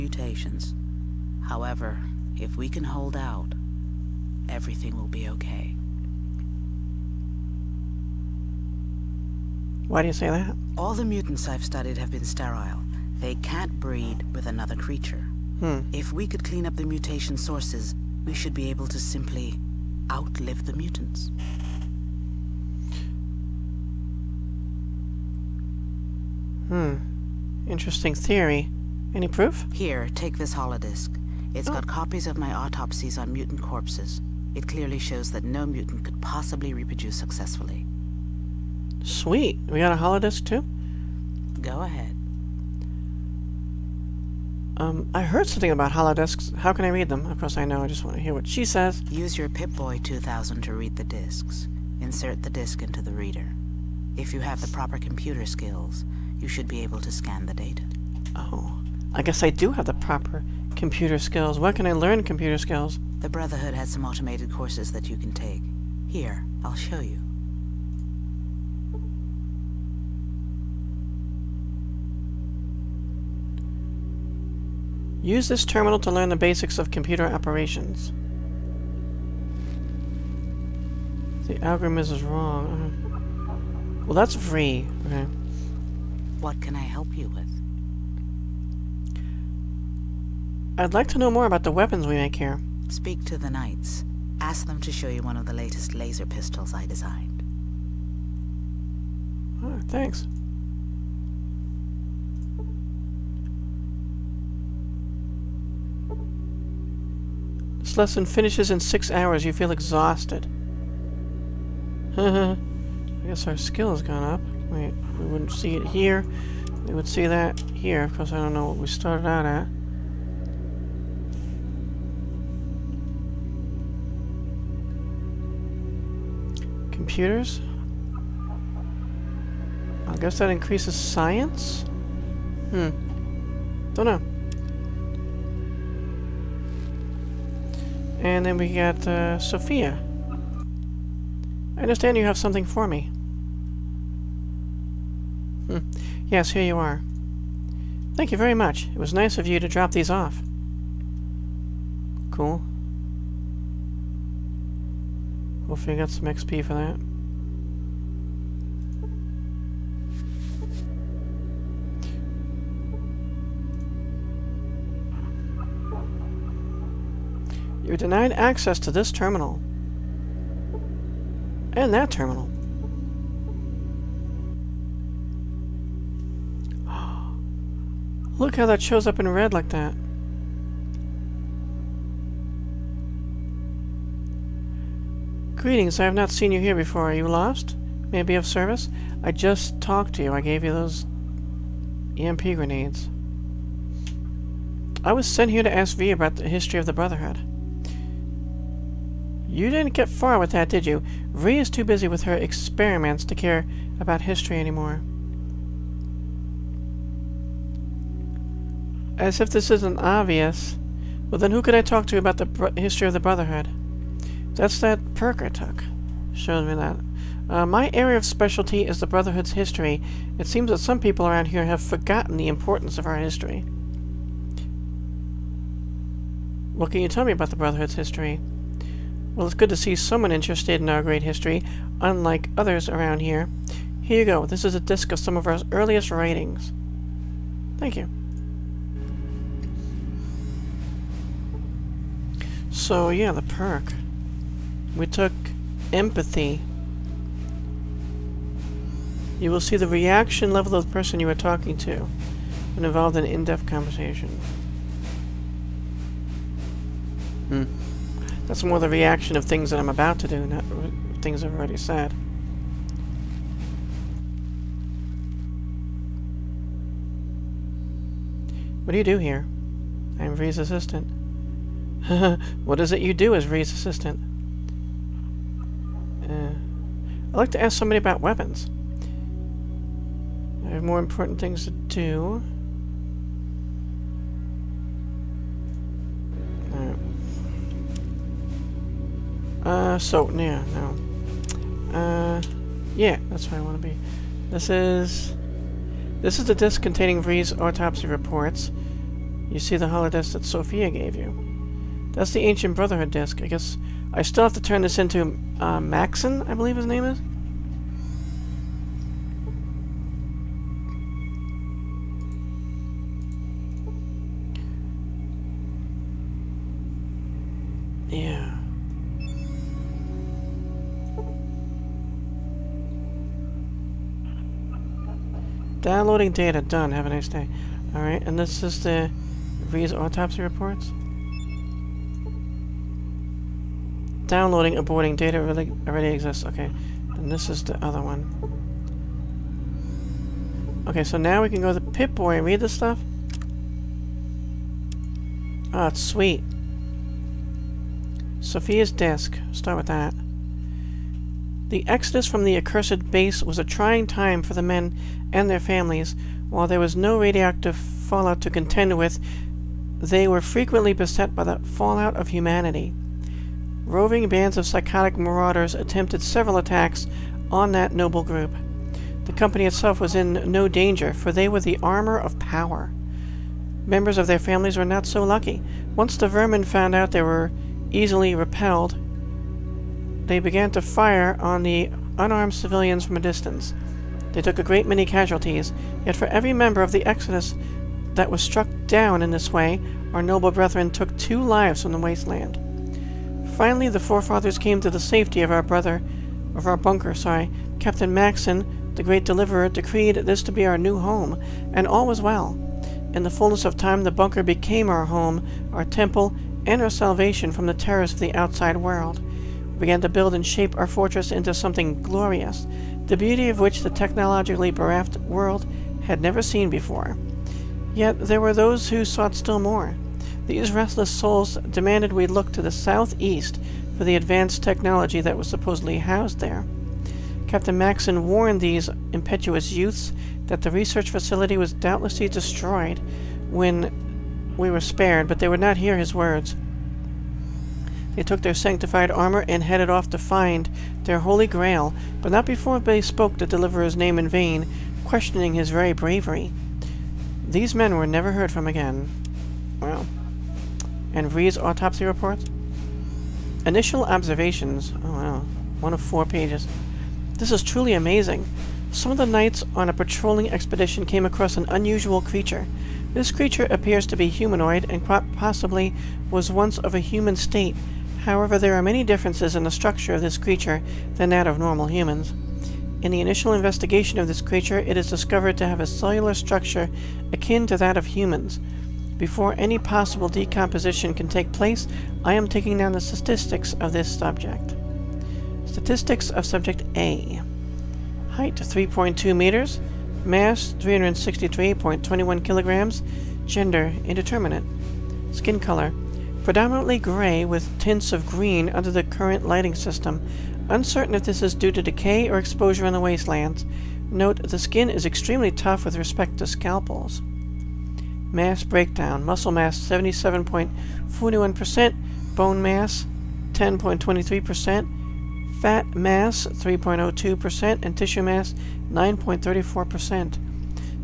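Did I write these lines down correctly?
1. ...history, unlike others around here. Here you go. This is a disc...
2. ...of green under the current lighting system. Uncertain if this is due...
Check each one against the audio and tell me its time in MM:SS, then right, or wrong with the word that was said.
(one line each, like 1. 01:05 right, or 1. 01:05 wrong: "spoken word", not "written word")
1. 03:51 right
2. 08:18 right.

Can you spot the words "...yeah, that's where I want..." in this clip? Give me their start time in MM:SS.
04:52.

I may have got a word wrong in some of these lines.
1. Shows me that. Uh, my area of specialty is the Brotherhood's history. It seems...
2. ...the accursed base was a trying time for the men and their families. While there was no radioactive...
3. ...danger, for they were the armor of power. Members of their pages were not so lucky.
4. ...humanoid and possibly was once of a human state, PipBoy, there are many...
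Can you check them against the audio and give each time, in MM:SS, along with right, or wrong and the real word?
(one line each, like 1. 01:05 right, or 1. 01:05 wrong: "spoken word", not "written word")
1. 03:36 right
2. 05:52 right
3. 06:10 wrong: "families", not "pages"
4. 07:44 wrong: "However", not "PipBoy".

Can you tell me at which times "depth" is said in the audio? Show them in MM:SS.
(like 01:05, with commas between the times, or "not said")
04:13.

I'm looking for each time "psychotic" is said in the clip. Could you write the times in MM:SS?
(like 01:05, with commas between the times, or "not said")
06:04.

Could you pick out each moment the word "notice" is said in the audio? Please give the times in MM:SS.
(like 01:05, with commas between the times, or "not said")
not said.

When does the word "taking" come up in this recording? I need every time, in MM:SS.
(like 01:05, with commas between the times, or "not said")
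08:02.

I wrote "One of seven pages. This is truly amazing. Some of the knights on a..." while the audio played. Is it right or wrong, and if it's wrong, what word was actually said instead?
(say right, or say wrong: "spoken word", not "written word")
wrong: "four", not "seven".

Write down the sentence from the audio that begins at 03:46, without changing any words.
What can you tell me about the Brotherhood's history?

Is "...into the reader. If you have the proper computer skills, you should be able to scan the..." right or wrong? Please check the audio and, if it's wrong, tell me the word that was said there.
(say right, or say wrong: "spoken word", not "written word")
right.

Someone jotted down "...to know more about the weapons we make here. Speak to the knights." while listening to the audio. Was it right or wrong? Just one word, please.
right.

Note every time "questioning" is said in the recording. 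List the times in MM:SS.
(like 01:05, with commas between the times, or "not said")
07:25.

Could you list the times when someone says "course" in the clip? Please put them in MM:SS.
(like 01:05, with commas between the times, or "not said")
00:47, 01:04.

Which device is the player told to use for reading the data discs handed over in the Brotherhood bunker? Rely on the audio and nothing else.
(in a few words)
Pip-Boy 2000.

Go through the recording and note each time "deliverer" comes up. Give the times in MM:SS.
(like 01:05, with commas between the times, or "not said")
06:39, 07:23.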